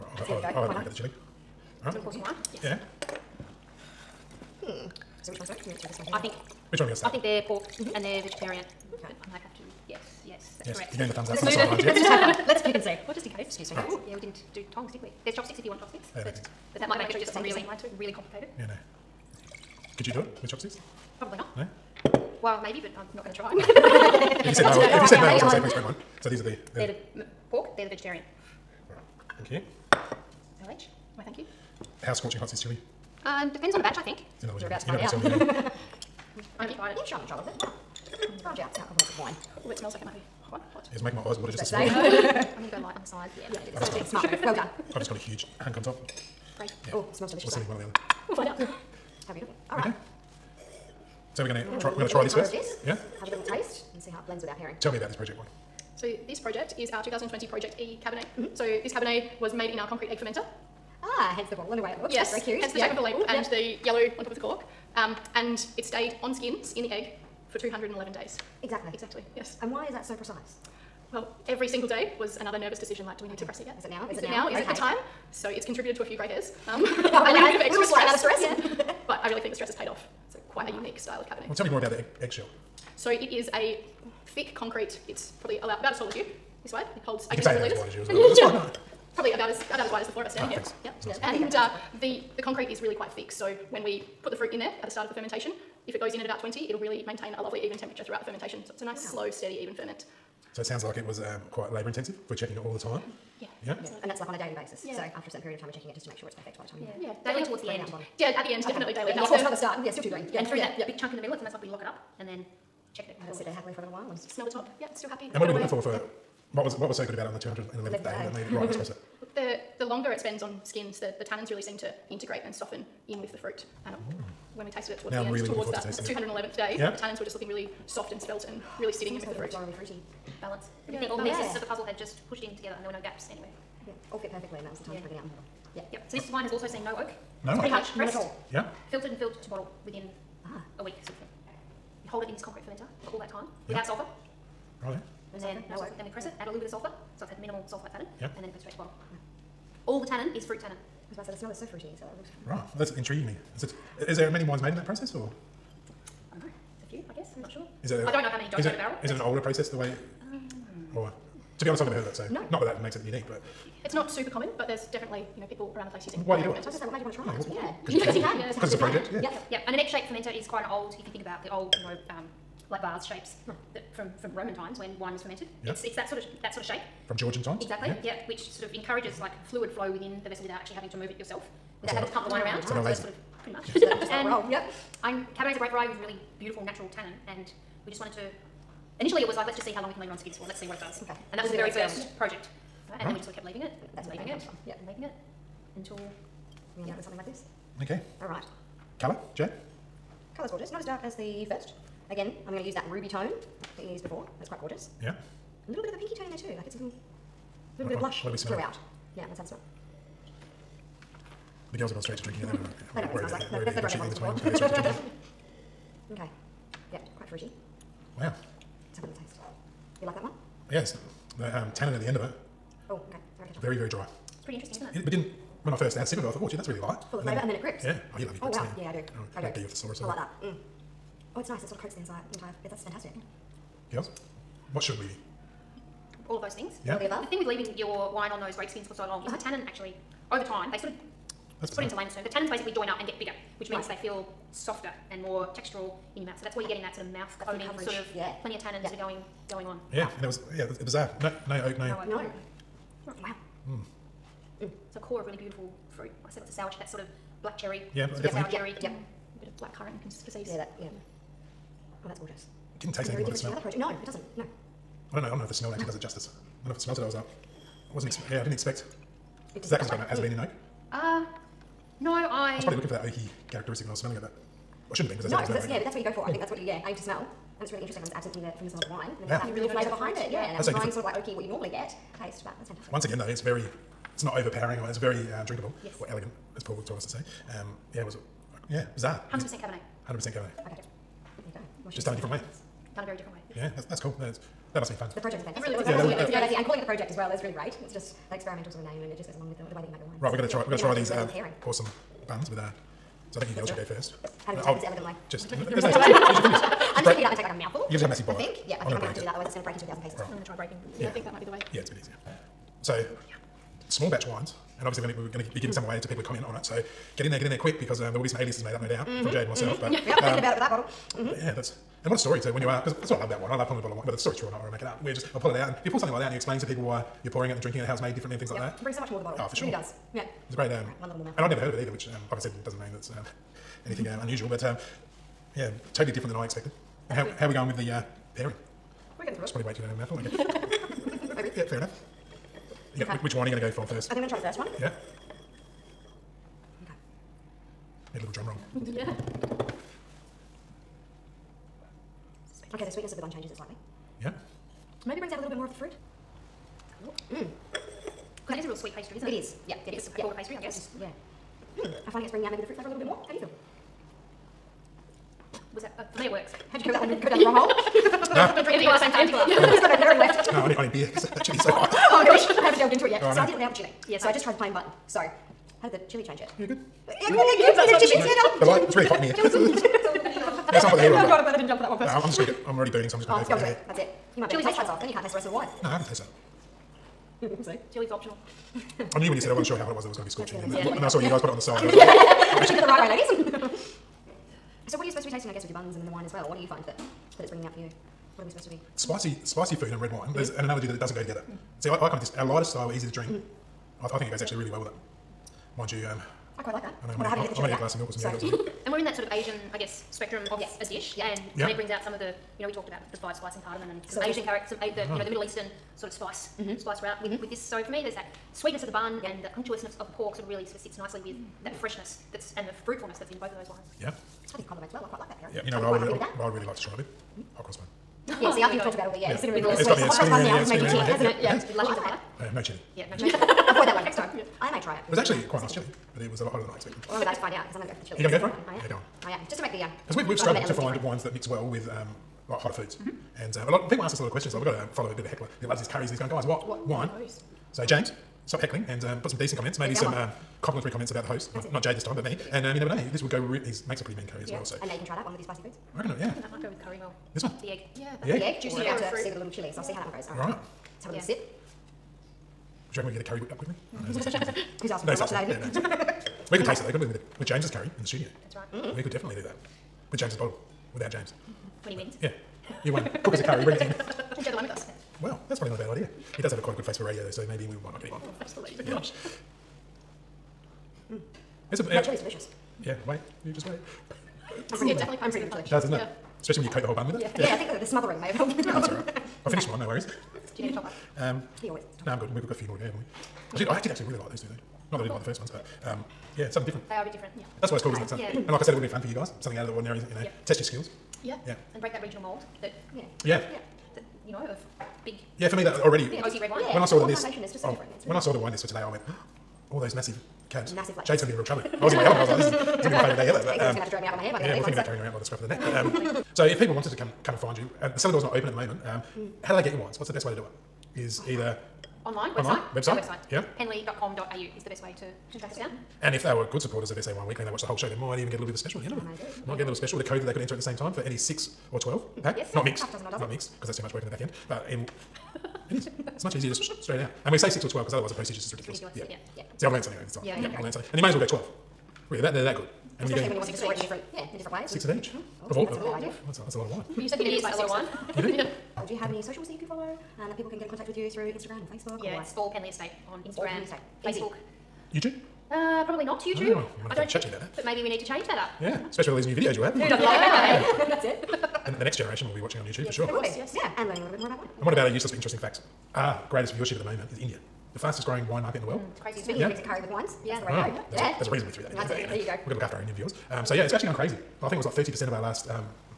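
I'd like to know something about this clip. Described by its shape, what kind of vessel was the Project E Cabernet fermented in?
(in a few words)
concrete egg fermenter.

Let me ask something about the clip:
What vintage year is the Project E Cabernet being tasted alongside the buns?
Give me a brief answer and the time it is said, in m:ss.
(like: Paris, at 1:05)
2020, at 0:57.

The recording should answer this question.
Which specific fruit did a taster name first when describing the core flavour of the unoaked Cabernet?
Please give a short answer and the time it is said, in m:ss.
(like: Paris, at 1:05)
black cherry, at 4:17.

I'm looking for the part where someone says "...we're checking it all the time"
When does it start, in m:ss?
1:42.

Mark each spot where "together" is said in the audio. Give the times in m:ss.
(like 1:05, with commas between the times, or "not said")
2:12, 6:41.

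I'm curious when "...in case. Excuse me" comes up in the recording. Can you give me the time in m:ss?
0:13.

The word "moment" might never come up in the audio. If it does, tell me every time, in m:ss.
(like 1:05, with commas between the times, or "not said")
8:38, 9:26.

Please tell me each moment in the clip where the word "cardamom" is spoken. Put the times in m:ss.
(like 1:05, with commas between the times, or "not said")
6:53.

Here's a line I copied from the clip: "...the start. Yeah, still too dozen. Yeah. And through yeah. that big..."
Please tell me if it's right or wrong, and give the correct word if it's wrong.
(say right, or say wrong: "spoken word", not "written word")
wrong: "green", not "dozen".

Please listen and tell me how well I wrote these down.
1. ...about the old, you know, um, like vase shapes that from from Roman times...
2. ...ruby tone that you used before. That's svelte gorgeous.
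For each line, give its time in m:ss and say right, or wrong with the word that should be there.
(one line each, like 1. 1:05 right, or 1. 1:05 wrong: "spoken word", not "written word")
1. 2:51 right
2. 3:22 wrong: "quite", not "svelte".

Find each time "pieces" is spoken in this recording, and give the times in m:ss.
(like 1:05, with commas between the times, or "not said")
2:11, 5:10.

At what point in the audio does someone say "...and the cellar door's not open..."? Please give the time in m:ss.
8:37.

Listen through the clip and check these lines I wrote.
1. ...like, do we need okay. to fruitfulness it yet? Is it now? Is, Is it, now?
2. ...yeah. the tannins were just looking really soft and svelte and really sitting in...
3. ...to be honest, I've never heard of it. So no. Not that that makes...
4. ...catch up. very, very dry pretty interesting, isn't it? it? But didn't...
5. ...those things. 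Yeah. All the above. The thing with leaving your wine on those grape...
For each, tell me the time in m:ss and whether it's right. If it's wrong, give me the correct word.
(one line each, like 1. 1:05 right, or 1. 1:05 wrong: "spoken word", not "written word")
1. 1:13 wrong: "press", not "fruitfulness"
2. 2:06 right
3. 2:41 right
4. 3:43 right
5. 3:56 right.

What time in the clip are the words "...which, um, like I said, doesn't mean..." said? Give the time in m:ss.
5:31.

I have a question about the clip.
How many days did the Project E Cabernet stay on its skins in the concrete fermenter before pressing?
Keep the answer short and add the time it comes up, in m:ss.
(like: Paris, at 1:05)
211, at 1:07.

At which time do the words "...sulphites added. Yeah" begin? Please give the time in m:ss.
2:27.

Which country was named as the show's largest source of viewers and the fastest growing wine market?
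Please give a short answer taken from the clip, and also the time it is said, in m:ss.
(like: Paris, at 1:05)
India, at 9:27.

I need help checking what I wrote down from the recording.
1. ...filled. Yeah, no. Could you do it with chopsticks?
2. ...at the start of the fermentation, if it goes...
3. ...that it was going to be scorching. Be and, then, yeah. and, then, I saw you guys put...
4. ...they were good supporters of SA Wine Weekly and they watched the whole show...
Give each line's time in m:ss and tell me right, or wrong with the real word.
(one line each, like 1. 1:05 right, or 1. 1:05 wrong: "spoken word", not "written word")
1. 0:18 wrong: "complicated", not "filled"
2. 1:34 right
3. 6:30 right
4. 8:46 right.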